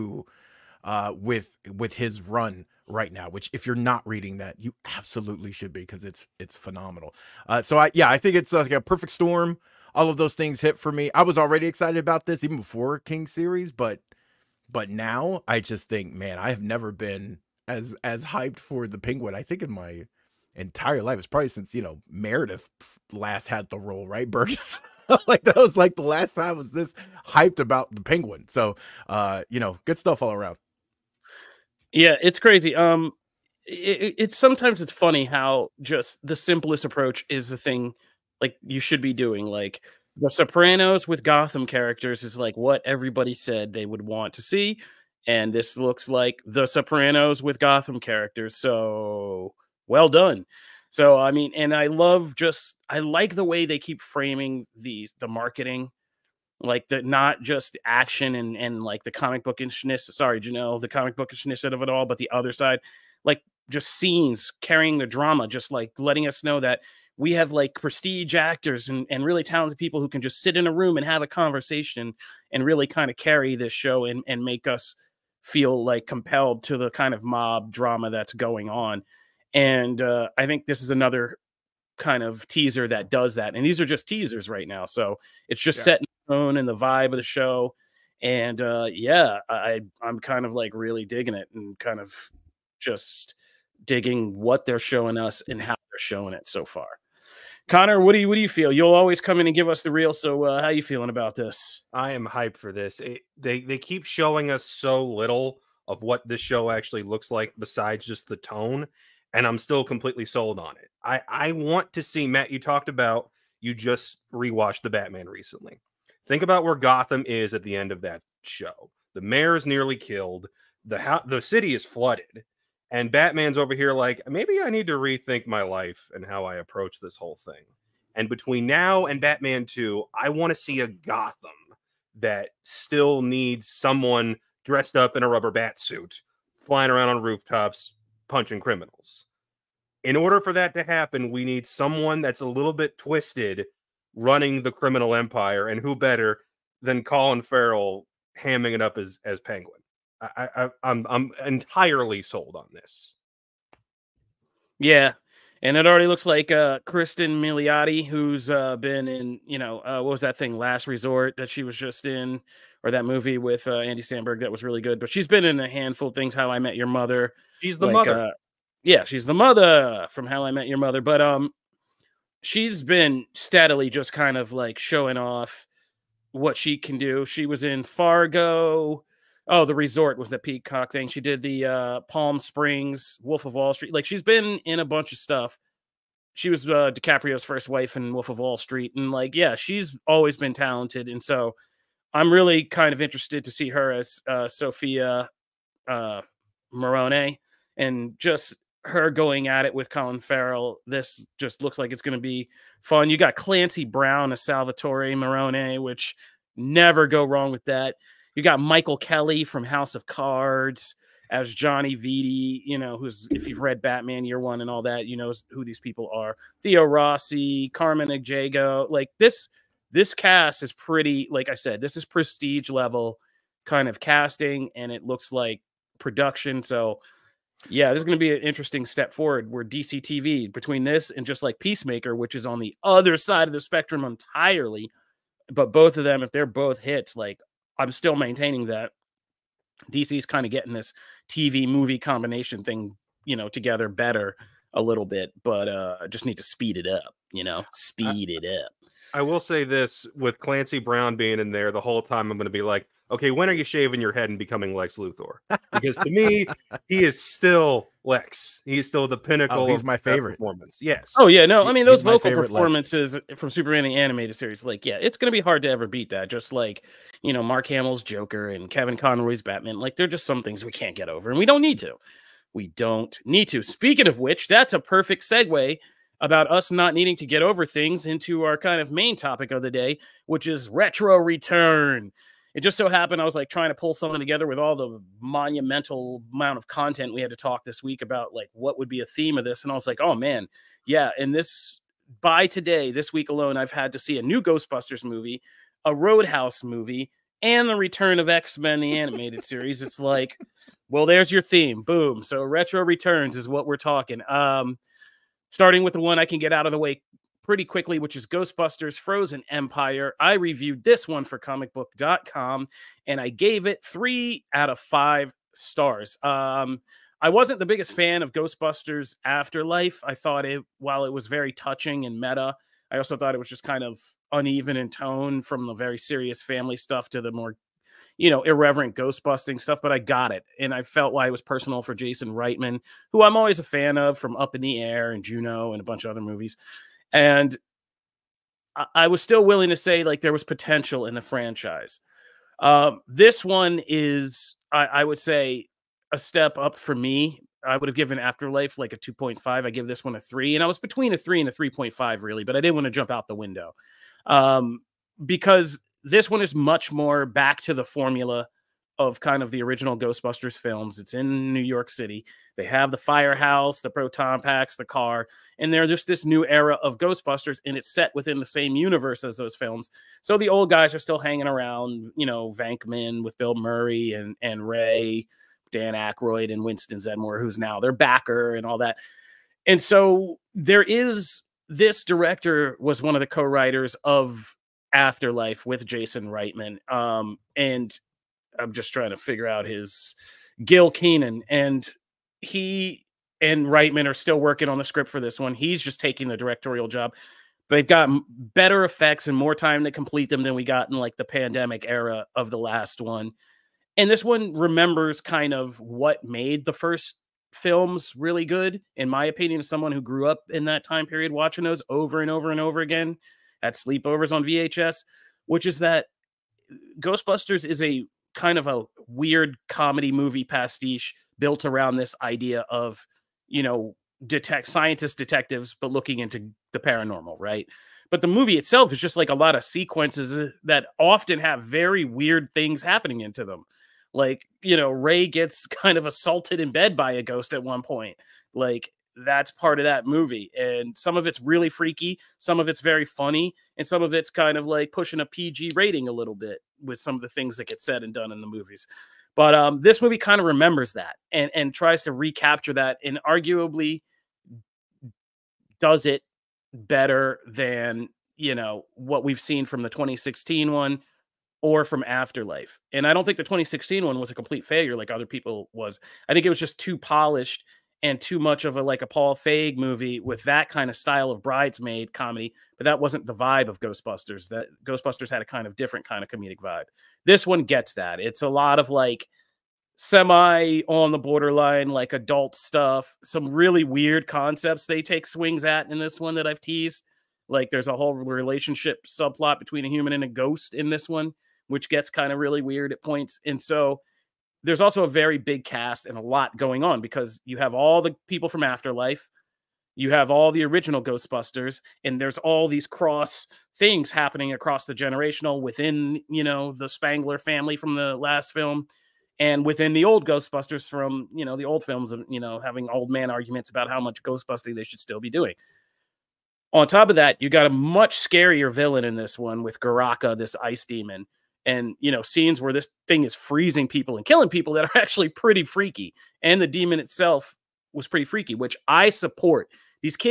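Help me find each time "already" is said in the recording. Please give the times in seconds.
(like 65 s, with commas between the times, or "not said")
11 s, 155 s.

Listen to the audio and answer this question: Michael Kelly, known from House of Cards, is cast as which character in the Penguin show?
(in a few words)
Johnny Vitti.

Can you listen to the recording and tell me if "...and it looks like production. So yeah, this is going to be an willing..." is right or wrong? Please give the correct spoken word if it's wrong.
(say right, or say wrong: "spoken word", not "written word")
wrong: "interesting", not "willing".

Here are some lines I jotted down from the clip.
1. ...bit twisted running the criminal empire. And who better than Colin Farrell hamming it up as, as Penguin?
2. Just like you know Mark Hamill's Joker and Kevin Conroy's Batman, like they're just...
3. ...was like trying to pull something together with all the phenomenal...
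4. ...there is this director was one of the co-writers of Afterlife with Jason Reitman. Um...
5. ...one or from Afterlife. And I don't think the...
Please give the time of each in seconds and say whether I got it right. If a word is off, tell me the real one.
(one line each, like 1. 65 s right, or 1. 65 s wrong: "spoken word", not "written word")
1. 142 s right
2. 266 s right
3. 283 s wrong: "monumental", not "phenomenal"
4. 380 s right
5. 460 s right.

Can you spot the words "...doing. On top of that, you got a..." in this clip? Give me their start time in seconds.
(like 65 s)
515 s.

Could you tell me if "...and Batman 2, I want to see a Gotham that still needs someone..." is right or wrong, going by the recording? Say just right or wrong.
right.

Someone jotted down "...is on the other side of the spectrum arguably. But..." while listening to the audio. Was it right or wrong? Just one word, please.
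wrong.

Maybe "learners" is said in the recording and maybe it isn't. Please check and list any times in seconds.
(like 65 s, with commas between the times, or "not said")
not said.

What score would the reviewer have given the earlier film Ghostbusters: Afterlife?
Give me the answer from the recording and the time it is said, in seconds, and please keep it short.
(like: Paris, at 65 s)
2.5, at 348 s.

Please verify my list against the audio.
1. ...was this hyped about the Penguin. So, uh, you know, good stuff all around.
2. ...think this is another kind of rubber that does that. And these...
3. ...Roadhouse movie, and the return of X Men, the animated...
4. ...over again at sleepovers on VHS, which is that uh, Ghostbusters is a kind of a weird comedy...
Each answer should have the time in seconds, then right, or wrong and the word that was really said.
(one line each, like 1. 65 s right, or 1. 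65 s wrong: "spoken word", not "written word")
1. 26 s right
2. 80 s wrong: "teaser", not "rubber"
3. 295 s right
4. 412 s right.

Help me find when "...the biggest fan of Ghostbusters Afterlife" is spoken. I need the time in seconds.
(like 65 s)
317 s.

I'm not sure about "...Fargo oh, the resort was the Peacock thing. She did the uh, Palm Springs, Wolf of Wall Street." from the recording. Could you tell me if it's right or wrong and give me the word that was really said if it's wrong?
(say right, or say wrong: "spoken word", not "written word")
right.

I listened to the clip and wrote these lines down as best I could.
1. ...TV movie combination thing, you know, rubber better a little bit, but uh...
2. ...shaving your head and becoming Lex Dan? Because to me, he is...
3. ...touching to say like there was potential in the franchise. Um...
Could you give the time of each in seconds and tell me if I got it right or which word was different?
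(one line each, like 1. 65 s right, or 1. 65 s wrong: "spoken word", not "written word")
1. 241 s wrong: "together", not "rubber"
2. 253 s wrong: "Luthor", not "Dan"
3. 339 s wrong: "willing", not "touching".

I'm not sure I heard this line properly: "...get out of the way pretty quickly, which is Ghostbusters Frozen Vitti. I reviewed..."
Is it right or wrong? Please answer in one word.
wrong.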